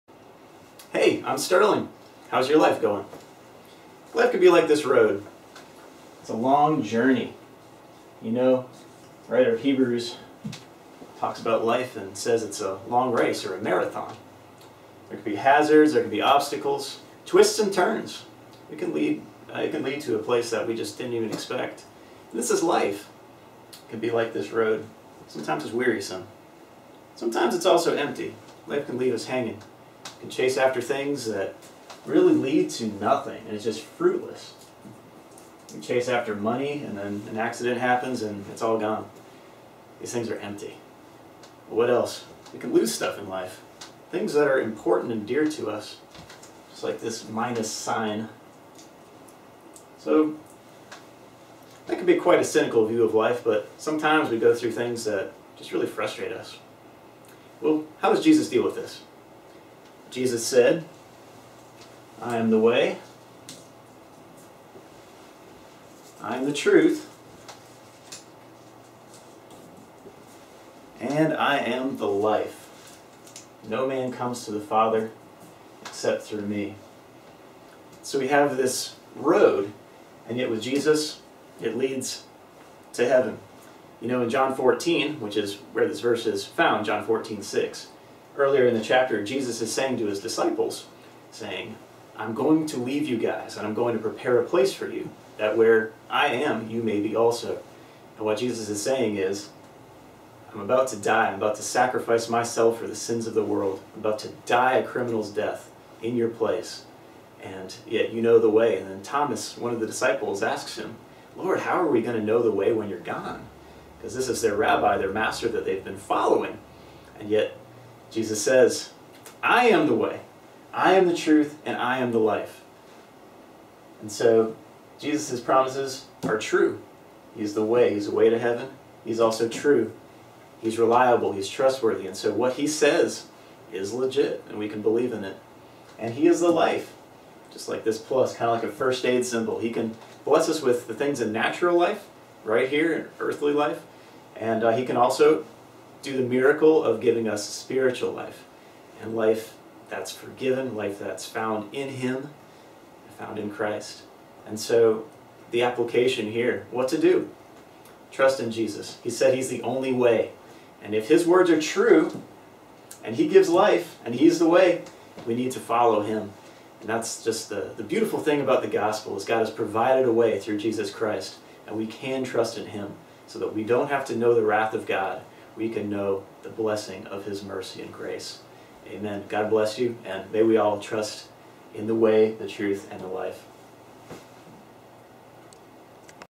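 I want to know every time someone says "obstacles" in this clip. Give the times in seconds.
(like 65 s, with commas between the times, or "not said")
16 s.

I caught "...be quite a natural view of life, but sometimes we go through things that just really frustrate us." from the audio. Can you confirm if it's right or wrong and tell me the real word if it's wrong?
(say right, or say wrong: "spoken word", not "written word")
wrong: "cynical", not "natural".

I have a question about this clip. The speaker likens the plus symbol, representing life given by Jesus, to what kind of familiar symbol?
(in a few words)
first aid symbol.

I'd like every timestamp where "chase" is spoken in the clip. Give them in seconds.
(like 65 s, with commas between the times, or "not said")
30 s, 35 s.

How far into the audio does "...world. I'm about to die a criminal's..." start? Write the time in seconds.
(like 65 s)
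103 s.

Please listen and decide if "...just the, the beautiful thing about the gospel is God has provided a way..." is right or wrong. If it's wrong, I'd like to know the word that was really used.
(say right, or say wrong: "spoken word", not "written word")
right.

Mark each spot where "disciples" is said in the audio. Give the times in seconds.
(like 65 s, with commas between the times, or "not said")
90 s, 109 s.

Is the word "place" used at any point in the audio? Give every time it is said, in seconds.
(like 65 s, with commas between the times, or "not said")
20 s, 94 s, 106 s.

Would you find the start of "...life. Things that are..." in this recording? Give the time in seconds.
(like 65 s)
43 s.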